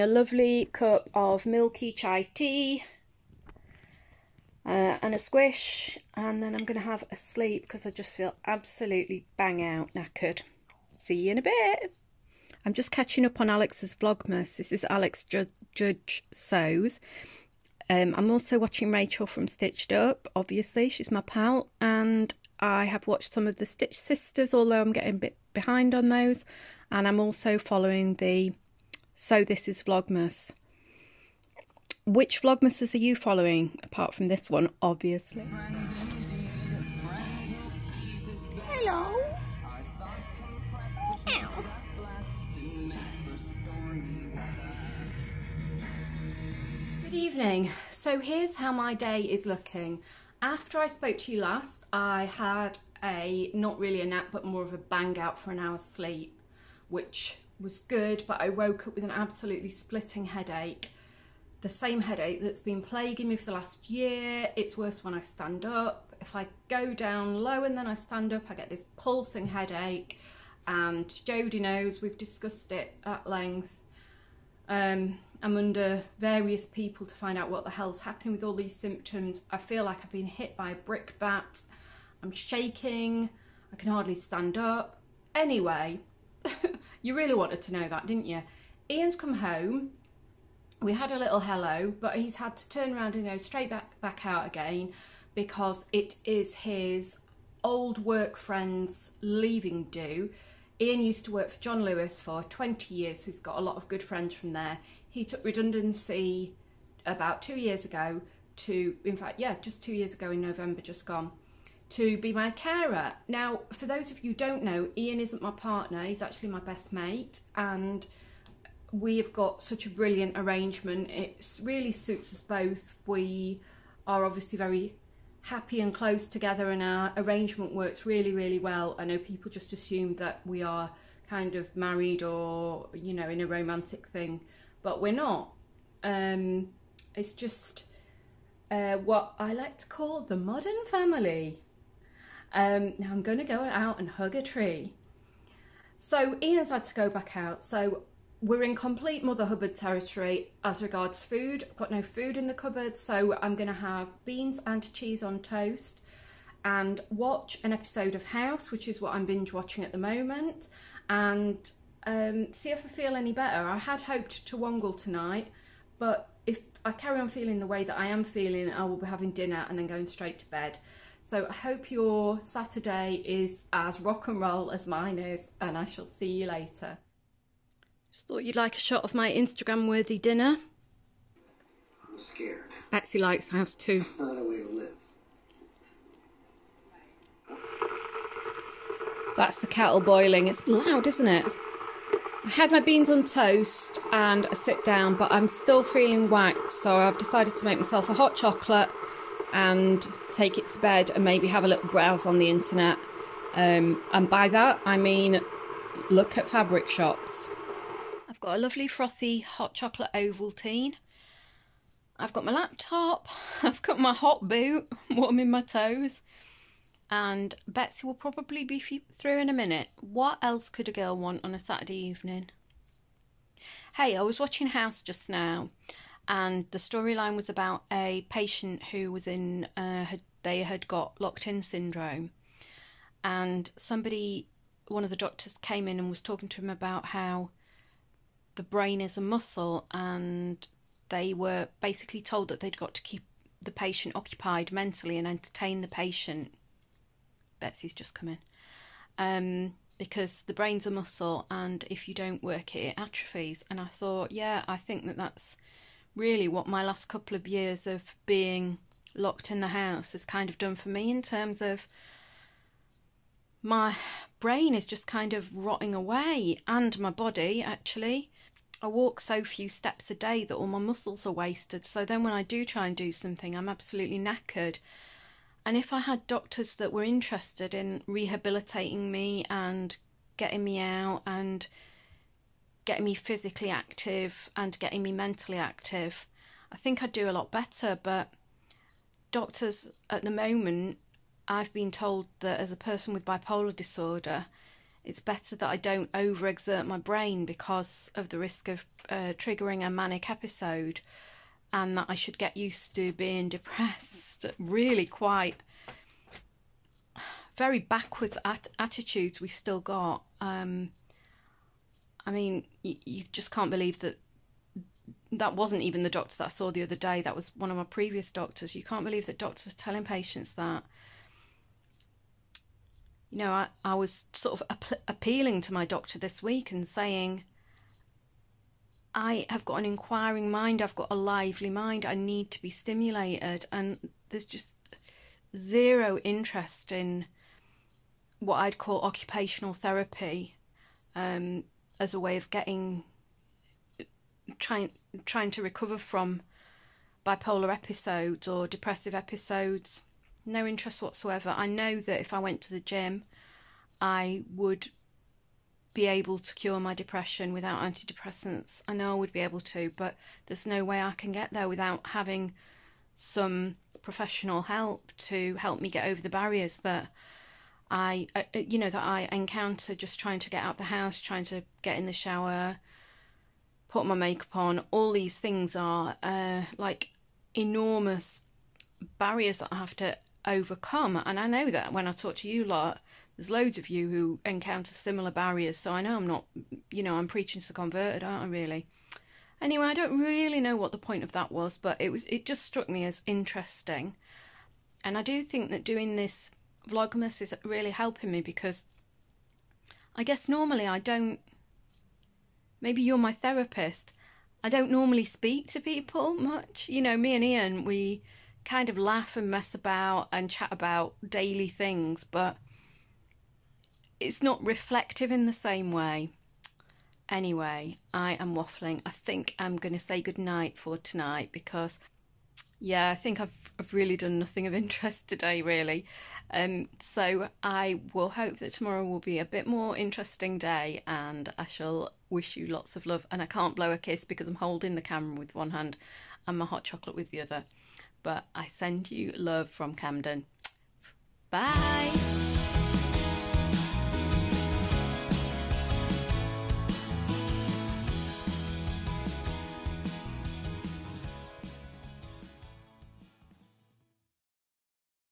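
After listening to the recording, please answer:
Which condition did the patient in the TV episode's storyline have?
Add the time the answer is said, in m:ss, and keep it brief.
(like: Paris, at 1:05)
Locked in syndrome, at 3:51.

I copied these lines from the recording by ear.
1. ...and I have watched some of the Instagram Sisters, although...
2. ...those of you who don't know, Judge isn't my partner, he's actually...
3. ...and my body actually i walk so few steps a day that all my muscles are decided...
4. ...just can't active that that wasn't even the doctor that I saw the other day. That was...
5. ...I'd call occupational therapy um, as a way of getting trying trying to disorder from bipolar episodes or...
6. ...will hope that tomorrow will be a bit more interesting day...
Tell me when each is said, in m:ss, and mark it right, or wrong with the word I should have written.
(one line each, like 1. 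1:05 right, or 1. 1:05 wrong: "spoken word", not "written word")
1. 0:21 wrong: "Stitch", not "Instagram"
2. 1:53 wrong: "Ian", not "Judge"
3. 4:26 wrong: "wasted", not "decided"
4. 5:13 wrong: "believe", not "active"
5. 5:38 wrong: "recover", not "disorder"
6. 7:08 right.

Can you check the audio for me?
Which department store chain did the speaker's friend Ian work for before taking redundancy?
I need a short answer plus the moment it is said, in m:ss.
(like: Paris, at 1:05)
John Lewis, at 1:41.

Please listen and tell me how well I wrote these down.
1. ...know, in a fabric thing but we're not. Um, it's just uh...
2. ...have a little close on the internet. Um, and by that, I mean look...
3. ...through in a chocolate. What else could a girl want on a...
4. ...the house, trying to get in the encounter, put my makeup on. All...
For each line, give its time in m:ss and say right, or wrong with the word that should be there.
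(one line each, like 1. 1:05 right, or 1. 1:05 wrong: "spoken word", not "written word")
1. 2:13 wrong: "romantic", not "fabric"
2. 3:21 wrong: "browse", not "close"
3. 3:38 wrong: "minute", not "chocolate"
4. 6:10 wrong: "shower", not "encounter".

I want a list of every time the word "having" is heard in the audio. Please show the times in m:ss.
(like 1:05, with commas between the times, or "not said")
2:49, 6:02.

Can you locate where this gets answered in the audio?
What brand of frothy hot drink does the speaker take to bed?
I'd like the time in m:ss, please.
3:30.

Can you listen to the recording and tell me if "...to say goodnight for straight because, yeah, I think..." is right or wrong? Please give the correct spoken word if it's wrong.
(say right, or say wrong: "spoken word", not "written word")
wrong: "tonight", not "straight".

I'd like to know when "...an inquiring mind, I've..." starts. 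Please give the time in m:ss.
5:29.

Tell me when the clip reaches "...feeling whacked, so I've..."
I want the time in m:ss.
3:15.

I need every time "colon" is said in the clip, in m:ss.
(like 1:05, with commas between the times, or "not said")
not said.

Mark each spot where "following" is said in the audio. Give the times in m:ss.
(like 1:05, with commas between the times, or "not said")
0:27, 0:33.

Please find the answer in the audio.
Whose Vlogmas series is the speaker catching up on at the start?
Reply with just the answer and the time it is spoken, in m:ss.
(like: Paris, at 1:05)
Alex Judge, at 0:14.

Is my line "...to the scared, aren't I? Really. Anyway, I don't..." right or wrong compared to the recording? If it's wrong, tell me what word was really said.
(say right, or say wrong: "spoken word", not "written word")
wrong: "converted", not "scared".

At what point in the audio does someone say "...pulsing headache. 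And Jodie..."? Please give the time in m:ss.
1:08.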